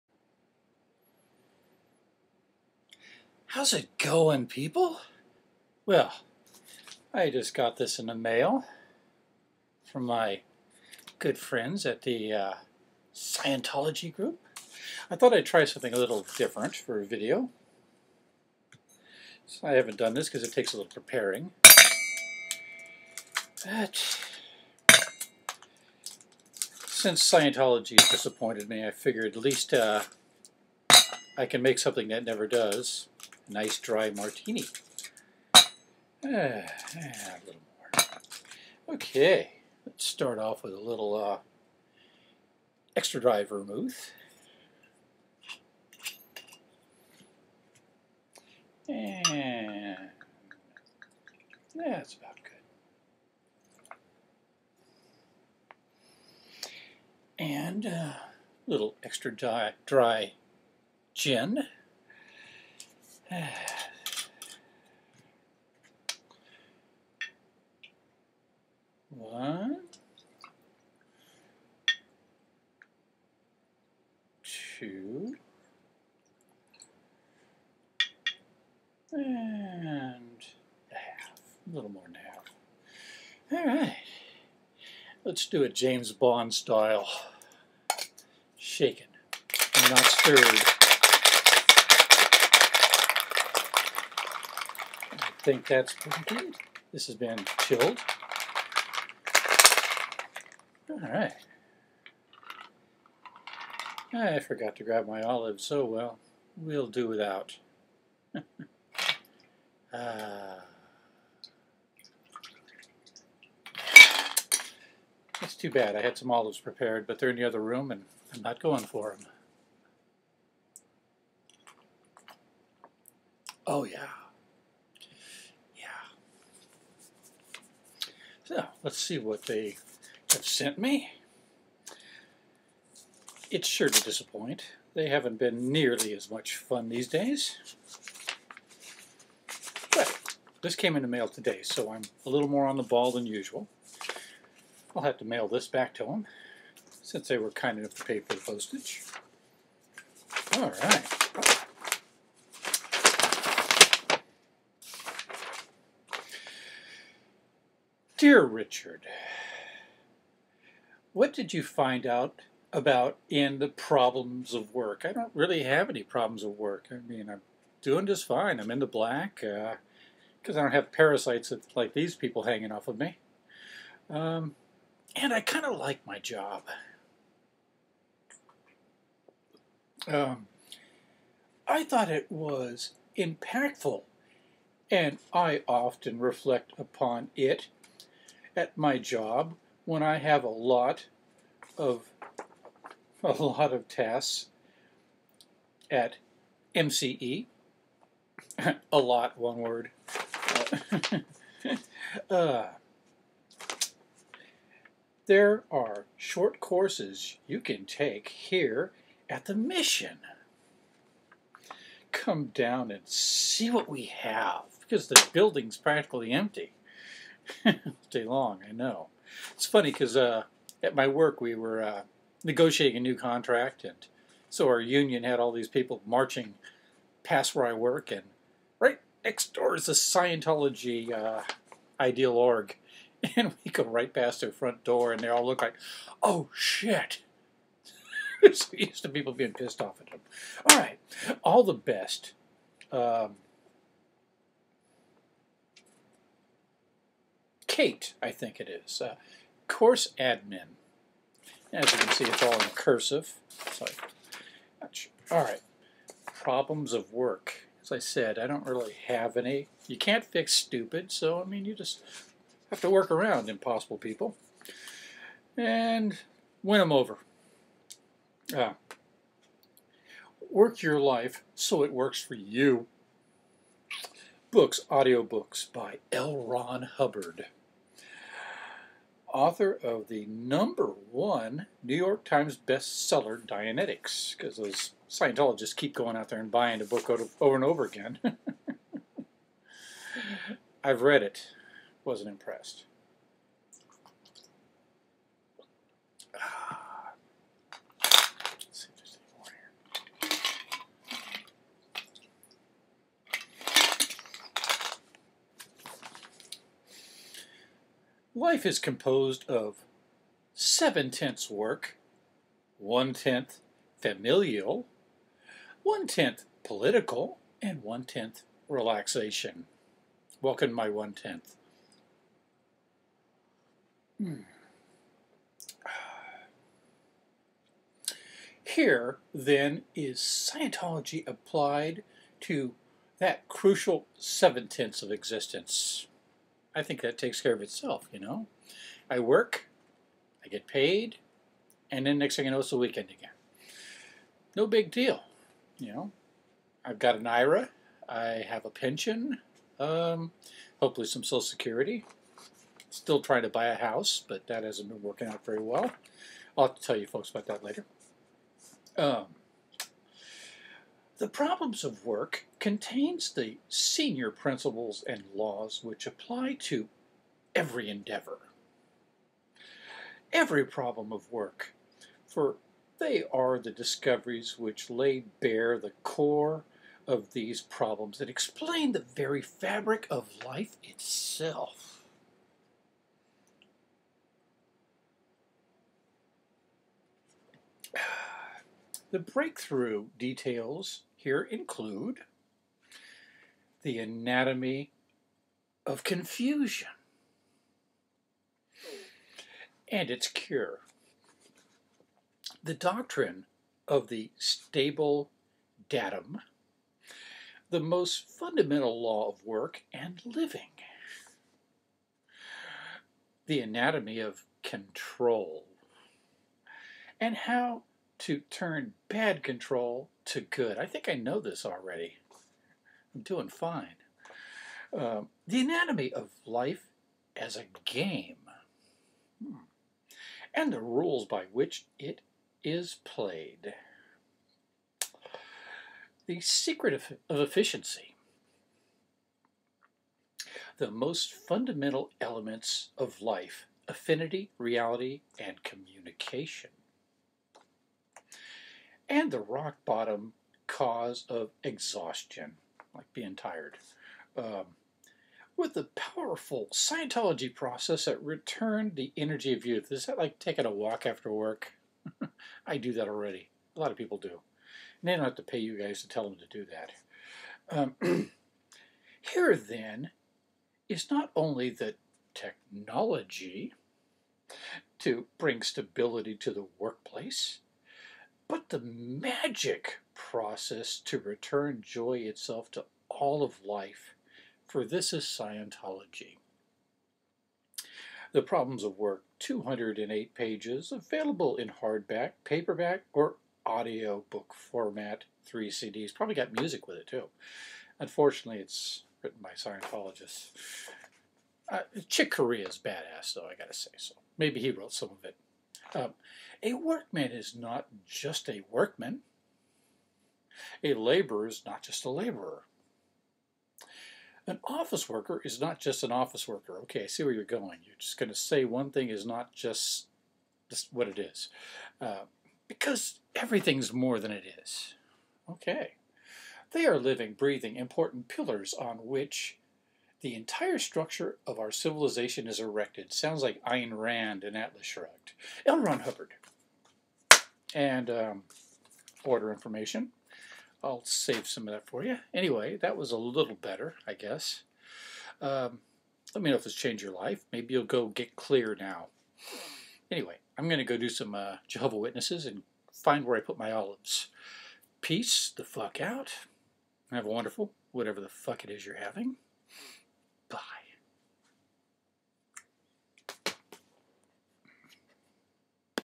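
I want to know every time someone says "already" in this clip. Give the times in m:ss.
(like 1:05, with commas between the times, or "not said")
7:01, 7:43.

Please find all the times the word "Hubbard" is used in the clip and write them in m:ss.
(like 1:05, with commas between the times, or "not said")
4:36, 8:56.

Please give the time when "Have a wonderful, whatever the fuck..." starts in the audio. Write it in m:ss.
9:17.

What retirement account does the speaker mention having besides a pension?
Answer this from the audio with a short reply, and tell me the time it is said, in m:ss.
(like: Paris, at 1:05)
IRA, at 5:47.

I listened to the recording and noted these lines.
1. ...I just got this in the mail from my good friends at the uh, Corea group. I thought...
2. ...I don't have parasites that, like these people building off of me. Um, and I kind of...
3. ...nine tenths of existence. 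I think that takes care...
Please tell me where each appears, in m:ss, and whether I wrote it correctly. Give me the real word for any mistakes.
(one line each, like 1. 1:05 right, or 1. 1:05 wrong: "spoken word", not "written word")
1. 0:07 wrong: "Scientology", not "Corea"
2. 2:50 wrong: "hanging", not "building"
3. 5:34 wrong: "seven", not "nine".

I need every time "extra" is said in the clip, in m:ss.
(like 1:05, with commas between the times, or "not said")
0:42, 0:59.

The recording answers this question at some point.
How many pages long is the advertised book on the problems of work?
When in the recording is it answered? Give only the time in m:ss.
8:09.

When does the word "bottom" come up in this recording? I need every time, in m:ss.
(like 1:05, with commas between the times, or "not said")
7:29.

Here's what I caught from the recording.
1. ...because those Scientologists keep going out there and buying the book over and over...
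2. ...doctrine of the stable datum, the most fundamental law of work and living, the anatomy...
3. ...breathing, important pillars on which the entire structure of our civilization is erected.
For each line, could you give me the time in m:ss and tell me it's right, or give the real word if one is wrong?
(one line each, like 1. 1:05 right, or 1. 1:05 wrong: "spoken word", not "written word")
1. 4:44 right
2. 6:42 right
3. 8:47 right.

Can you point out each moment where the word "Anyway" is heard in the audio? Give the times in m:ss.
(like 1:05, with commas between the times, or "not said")
9:02, 9:10.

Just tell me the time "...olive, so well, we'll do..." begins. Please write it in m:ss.
1:45.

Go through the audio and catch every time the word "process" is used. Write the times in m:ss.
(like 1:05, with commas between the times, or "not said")
7:37, 8:00.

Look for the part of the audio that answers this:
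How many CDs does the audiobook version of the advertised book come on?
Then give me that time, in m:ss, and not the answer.
8:15.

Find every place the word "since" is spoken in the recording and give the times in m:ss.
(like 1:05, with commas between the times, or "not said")
0:26, 2:27.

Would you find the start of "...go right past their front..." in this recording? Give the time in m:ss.
3:53.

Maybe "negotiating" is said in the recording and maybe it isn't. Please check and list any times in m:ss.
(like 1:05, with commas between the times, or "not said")
3:42.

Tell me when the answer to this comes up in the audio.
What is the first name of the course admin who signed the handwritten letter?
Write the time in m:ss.
4:07.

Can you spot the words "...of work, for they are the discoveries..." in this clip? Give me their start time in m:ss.
6:11.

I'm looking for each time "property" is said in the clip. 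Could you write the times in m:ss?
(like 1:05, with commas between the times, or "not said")
not said.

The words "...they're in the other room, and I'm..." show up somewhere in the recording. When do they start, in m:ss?
1:57.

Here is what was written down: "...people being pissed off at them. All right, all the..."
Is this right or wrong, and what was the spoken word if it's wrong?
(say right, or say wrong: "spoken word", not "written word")
right.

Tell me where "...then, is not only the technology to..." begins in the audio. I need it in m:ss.
7:49.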